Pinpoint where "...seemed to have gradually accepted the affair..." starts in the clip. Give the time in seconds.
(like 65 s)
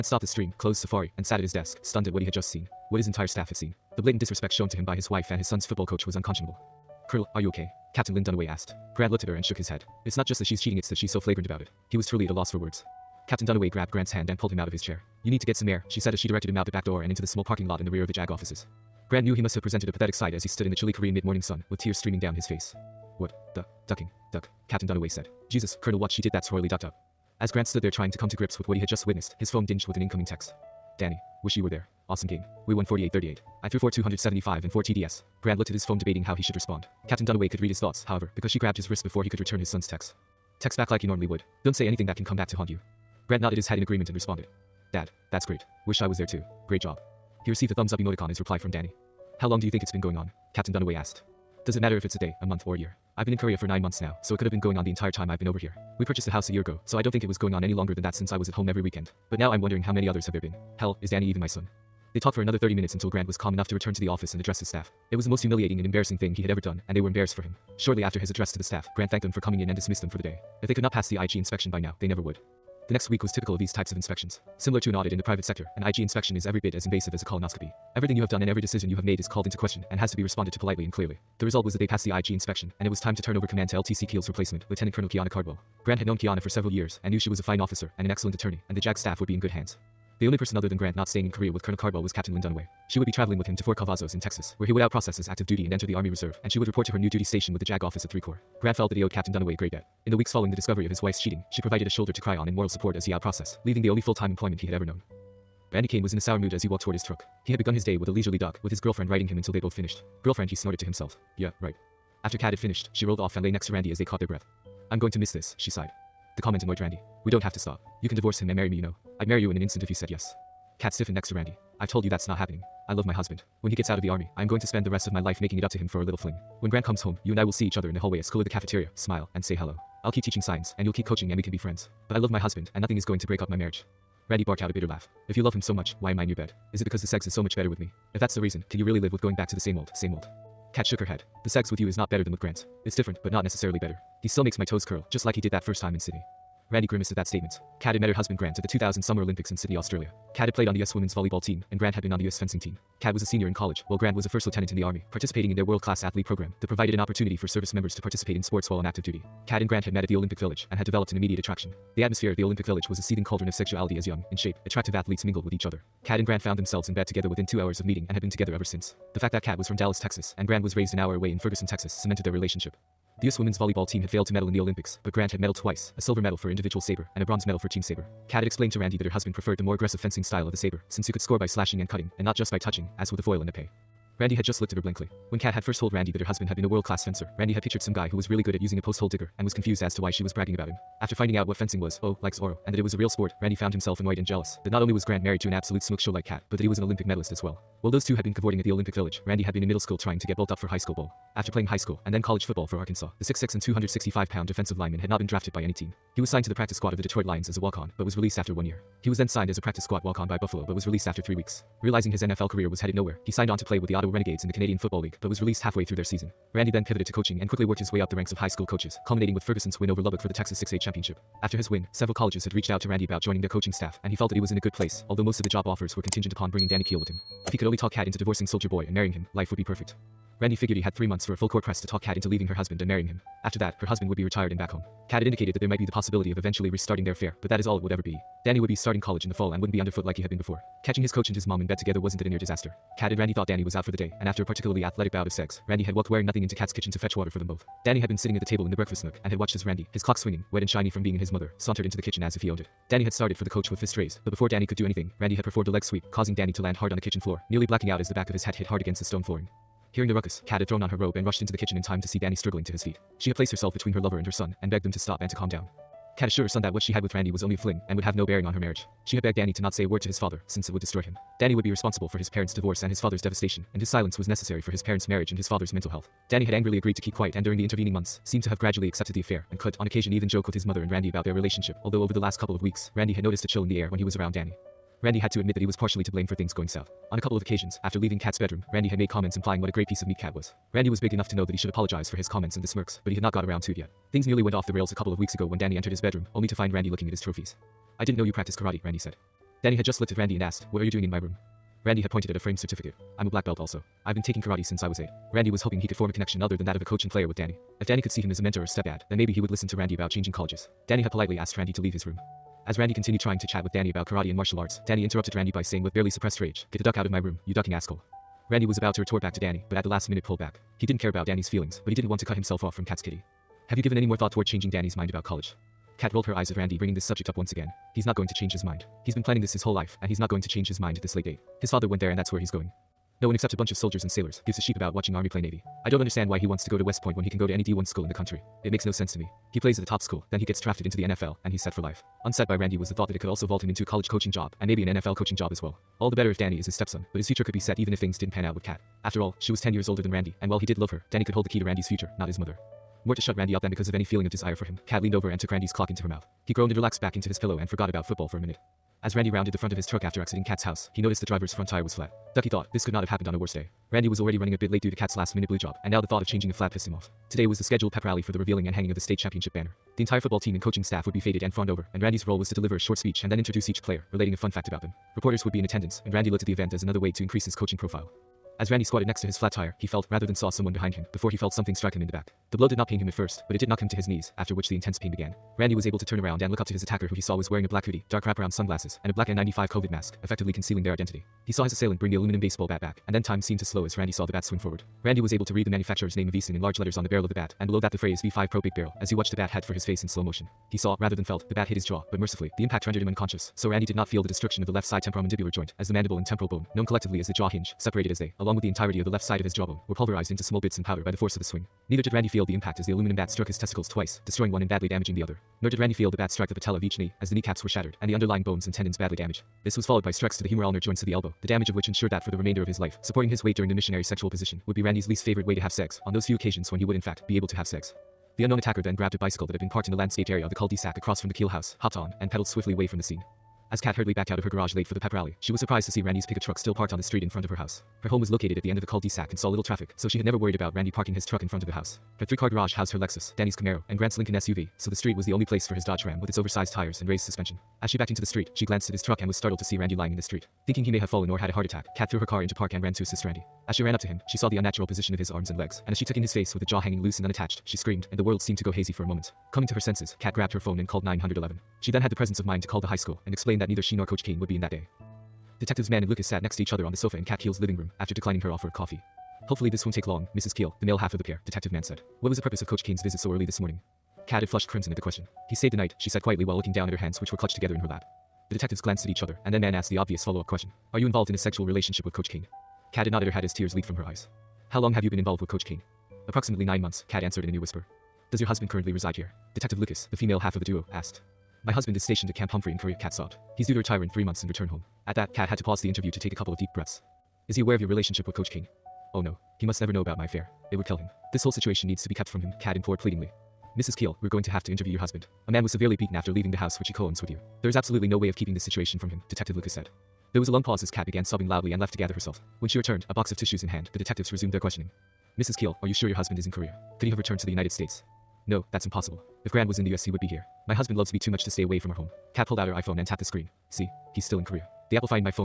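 278 s.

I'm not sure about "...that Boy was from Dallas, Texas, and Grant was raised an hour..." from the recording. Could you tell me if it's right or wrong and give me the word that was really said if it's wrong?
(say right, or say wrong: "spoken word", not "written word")
wrong: "Kat", not "Boy".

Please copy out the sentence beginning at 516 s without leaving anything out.
Could he have returned to the United States?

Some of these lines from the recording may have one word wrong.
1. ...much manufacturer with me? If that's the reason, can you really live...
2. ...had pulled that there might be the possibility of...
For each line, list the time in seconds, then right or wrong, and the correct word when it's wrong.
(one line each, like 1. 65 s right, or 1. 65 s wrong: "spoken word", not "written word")
1. 137 s wrong: "better", not "manufacturer"
2. 235 s wrong: "indicated", not "pulled".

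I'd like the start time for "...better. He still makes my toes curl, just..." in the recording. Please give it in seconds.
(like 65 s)
143 s.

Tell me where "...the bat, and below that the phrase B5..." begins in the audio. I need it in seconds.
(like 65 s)
397 s.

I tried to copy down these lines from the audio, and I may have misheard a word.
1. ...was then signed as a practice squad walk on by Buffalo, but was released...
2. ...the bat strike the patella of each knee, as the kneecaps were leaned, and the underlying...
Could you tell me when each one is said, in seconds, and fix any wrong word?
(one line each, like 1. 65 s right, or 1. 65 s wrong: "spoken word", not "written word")
1. 209 s right
2. 416 s wrong: "shattered", not "leaned".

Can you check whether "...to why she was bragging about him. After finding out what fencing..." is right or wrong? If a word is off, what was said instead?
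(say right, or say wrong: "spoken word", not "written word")
right.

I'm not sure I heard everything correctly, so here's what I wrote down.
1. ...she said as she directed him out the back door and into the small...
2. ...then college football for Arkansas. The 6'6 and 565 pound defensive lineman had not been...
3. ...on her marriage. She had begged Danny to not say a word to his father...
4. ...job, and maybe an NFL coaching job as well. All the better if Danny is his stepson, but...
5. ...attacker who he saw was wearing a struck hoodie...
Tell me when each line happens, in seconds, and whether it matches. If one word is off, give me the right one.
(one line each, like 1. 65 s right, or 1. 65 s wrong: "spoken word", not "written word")
1. 15 s right
2. 202 s wrong: "265", not "565"
3. 268 s right
4. 344 s right
5. 386 s wrong: "black", not "struck".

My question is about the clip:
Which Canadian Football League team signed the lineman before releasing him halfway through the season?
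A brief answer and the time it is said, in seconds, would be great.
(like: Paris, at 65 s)
Ottawa Renegades, at 213 s.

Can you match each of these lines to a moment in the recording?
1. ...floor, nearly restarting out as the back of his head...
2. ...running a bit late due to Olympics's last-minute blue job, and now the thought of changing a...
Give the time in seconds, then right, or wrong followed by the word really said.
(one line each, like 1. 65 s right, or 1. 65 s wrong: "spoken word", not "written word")
1. 257 s wrong: "blacking", not "restarting"
2. 364 s wrong: "Kat", not "Olympics".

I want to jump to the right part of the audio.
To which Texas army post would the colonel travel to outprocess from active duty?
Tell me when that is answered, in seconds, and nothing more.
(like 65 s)
93 s.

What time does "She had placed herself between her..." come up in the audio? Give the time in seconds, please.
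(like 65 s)
263 s.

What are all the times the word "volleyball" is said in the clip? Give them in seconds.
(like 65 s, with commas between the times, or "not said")
151 s, 173 s.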